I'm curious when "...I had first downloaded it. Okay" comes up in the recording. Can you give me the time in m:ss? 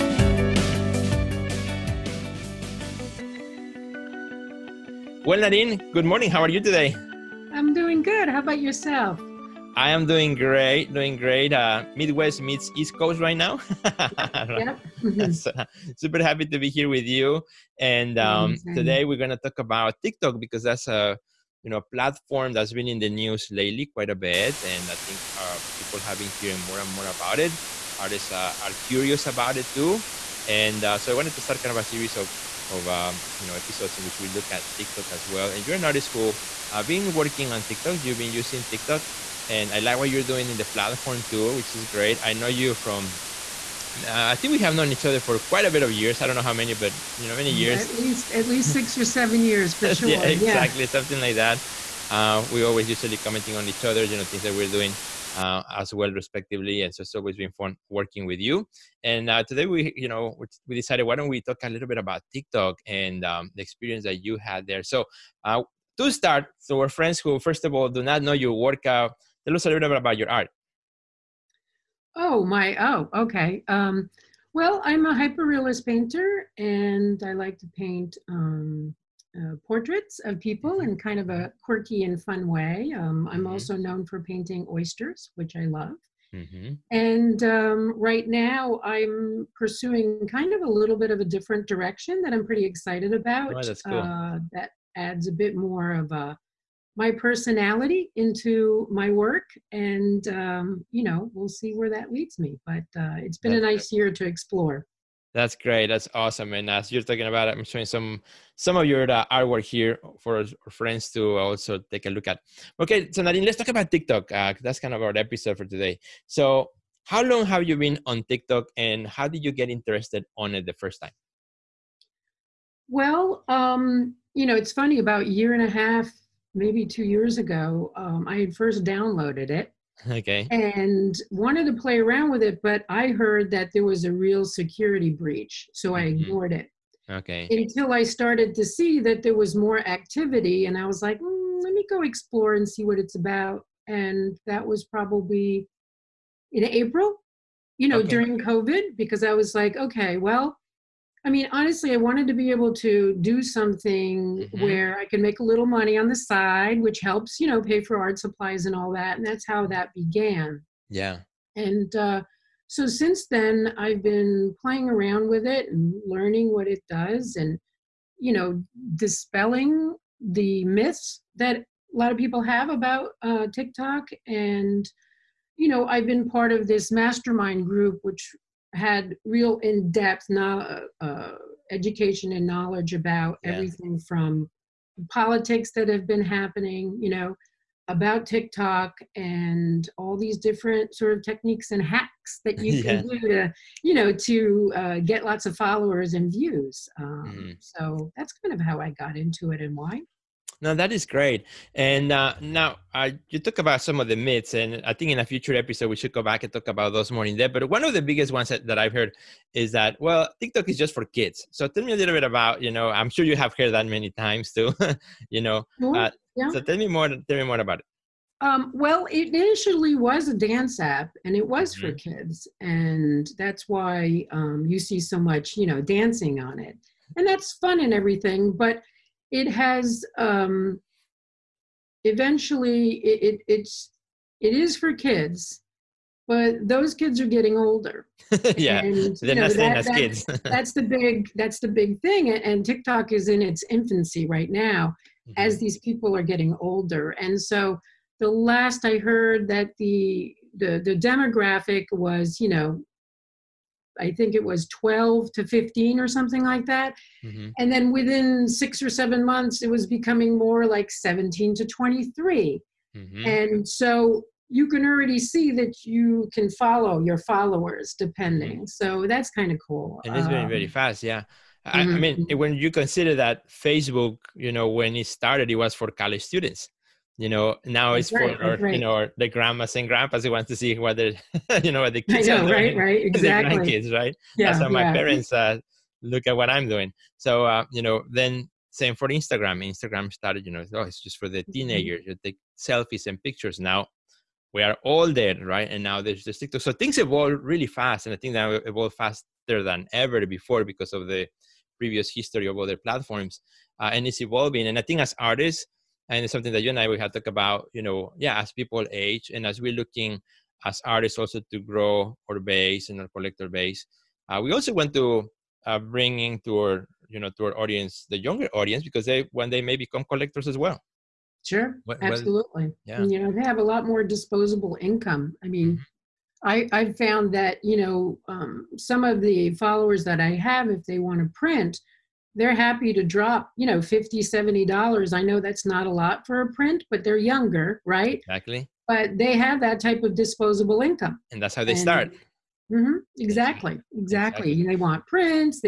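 2:08.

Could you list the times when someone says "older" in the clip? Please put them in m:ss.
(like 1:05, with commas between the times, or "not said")
3:57, 4:06.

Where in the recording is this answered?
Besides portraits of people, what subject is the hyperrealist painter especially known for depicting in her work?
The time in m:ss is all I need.
1:24.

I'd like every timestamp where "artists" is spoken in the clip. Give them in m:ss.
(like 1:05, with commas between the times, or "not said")
0:27, 0:35, 5:05, 5:10.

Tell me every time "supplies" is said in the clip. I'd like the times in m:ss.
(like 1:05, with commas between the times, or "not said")
2:38.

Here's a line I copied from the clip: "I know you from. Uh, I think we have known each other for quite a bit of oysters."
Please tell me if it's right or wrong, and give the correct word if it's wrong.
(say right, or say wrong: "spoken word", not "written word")
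wrong: "years", not "oysters".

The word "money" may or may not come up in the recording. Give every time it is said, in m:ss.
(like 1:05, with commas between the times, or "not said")
2:35.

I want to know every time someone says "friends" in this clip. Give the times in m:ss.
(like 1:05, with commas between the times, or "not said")
1:06, 1:50.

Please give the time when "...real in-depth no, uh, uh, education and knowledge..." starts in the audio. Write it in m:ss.
2:59.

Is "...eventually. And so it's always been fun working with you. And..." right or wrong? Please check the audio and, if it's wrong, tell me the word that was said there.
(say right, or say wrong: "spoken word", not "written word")
wrong: "respectively", not "eventually".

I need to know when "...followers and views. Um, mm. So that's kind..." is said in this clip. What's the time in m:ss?
3:15.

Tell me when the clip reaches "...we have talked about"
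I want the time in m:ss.
5:06.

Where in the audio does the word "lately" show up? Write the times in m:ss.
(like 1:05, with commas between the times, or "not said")
0:23.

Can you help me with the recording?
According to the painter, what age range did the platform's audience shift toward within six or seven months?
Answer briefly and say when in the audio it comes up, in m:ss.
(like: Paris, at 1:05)
17 to 23, at 4:20.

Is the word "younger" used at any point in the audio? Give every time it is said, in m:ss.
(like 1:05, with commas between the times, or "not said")
5:18, 5:37.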